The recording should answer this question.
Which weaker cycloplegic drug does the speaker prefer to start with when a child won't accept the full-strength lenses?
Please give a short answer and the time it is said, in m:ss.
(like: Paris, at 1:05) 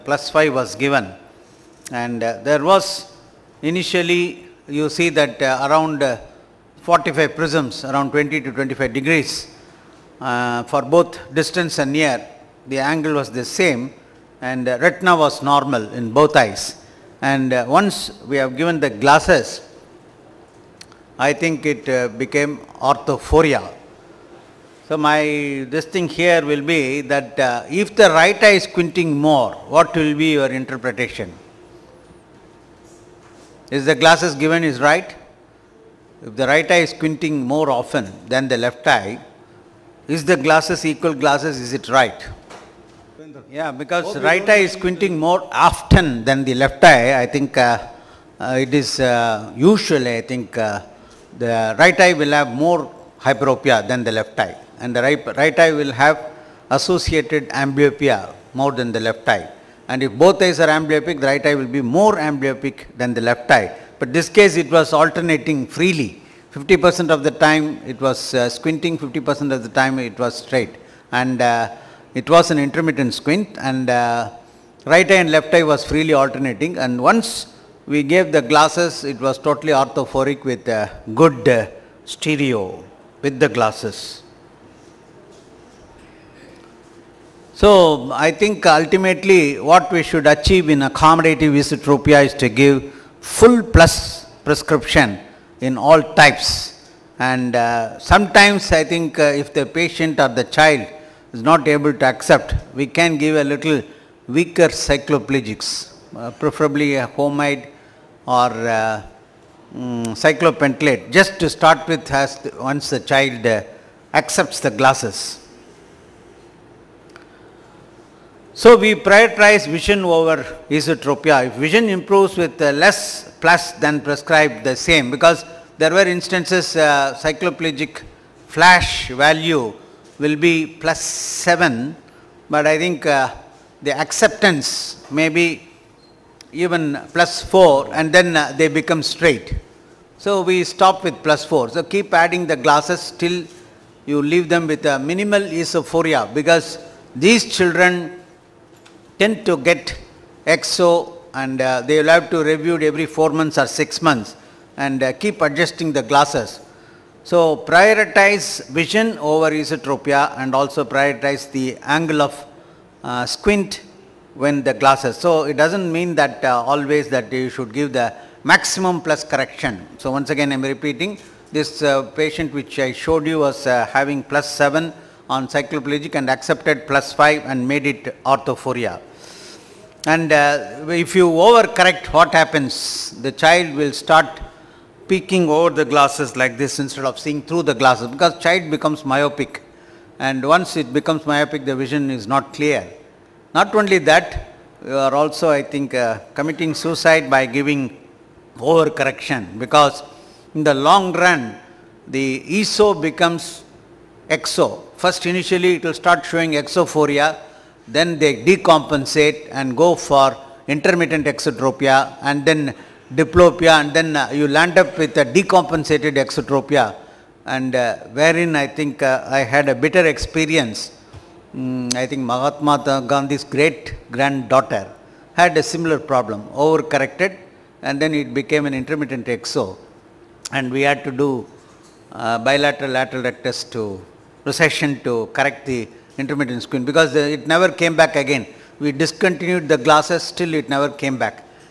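Homide, at 1:47.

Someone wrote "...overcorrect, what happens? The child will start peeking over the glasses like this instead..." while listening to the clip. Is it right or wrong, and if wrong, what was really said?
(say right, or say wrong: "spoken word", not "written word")
right.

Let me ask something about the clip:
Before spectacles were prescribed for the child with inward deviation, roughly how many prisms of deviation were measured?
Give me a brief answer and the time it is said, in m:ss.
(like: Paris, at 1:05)
45 prisms, at 0:06.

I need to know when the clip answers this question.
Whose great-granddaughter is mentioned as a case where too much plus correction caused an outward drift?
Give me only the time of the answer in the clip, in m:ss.
3:42.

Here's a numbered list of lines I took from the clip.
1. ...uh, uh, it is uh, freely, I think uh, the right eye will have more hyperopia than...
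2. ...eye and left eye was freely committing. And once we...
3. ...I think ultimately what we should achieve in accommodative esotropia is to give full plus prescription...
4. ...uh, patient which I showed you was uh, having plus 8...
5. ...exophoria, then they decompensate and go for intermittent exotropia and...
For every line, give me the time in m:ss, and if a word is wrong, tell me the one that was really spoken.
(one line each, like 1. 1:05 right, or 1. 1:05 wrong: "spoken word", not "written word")
1. 0:47 wrong: "usually", not "freely"
2. 1:15 wrong: "alternating", not "committing"
3. 1:28 right
4. 2:51 wrong: "7", not "8"
5. 3:26 right.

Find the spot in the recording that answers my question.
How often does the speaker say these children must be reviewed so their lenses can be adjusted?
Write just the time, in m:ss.
2:32.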